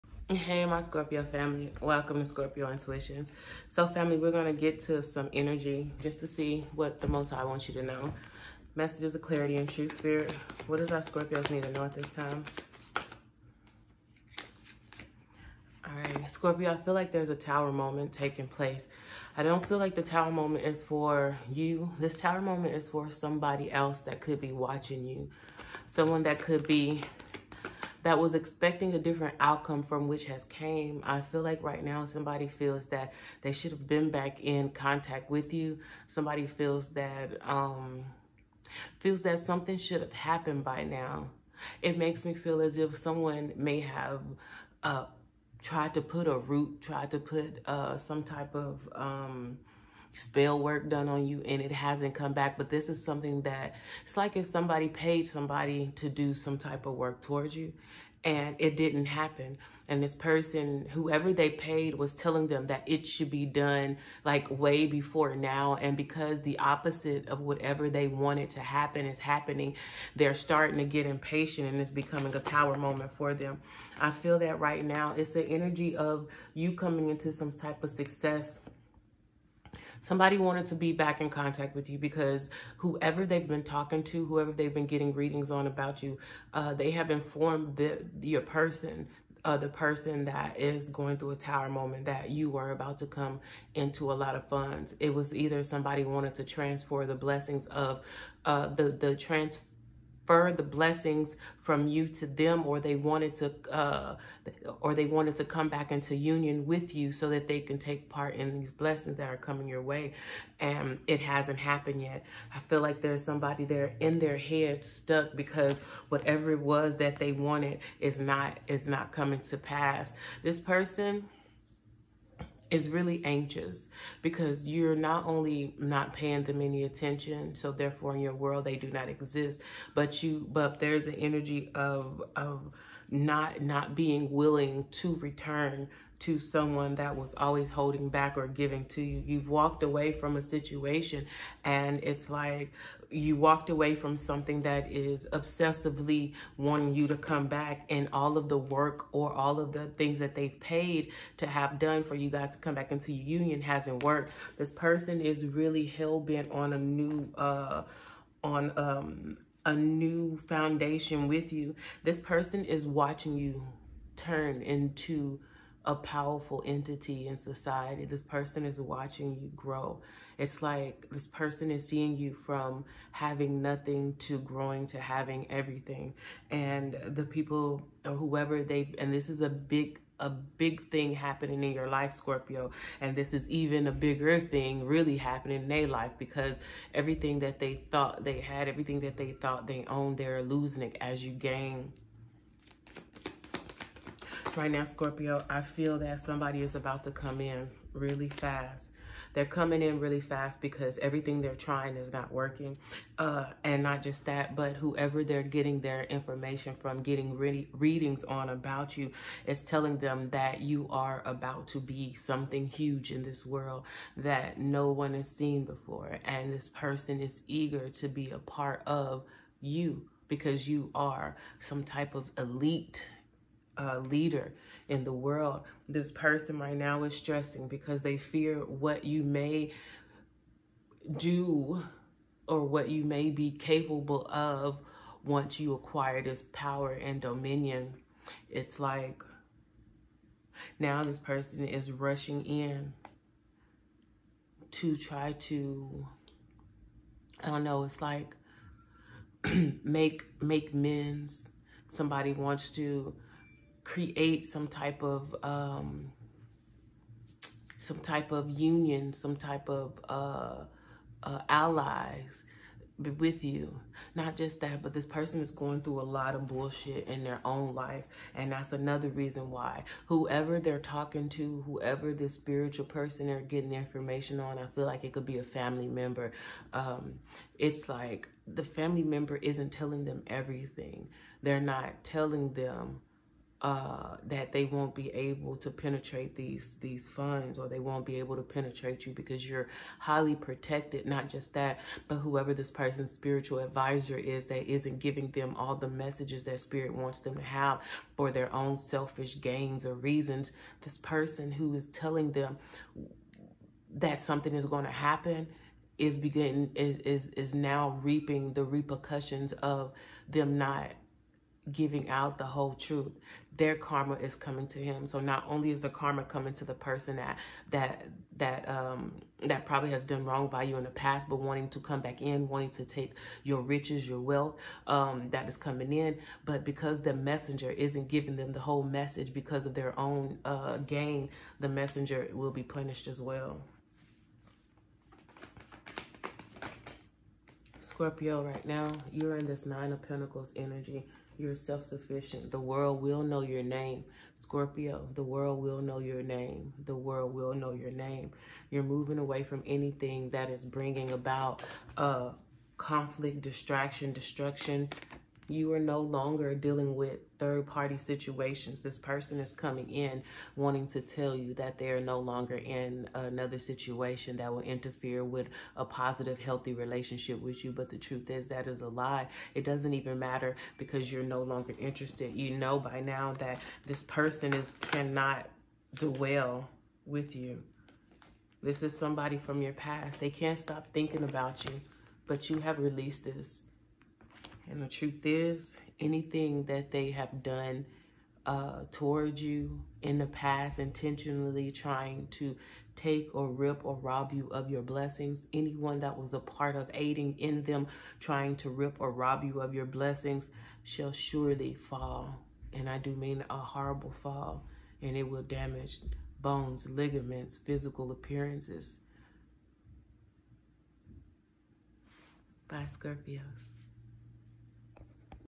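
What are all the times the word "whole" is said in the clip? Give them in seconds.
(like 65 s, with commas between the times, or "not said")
312 s, 328 s.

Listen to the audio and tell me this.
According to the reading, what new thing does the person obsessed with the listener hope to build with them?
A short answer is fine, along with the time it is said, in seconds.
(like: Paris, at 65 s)
A new foundation, at 159 s.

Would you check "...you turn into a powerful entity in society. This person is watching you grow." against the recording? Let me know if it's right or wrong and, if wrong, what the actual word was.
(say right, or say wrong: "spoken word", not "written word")
right.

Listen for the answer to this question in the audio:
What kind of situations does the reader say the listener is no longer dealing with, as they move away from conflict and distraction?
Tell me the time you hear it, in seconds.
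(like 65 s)
357 s.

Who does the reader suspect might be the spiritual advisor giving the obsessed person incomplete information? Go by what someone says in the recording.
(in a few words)
A family member.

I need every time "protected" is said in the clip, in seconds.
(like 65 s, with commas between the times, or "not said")
290 s.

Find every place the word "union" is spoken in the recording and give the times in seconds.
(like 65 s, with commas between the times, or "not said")
106 s, 153 s, 258 s.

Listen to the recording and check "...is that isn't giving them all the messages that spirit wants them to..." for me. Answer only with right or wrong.
right.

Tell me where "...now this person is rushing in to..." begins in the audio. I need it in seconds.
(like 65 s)
240 s.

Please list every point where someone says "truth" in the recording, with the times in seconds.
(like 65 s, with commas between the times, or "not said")
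312 s, 367 s, 384 s.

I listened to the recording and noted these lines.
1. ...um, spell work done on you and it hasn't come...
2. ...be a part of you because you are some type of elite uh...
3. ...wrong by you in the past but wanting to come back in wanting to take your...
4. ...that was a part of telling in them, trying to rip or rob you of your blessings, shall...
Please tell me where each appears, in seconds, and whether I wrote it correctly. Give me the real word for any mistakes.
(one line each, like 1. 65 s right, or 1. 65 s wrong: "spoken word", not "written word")
1. 48 s right
2. 218 s right
3. 320 s right
4. 396 s wrong: "aiding", not "telling".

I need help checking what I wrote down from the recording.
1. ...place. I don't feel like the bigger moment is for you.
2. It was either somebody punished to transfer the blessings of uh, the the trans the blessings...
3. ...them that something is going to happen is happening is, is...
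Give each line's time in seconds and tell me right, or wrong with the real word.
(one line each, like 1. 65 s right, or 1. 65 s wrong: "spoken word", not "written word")
1. 18 s wrong: "tower", not "bigger"
2. 94 s wrong: "wanted", not "punished"
3. 302 s wrong: "beginning", not "happening".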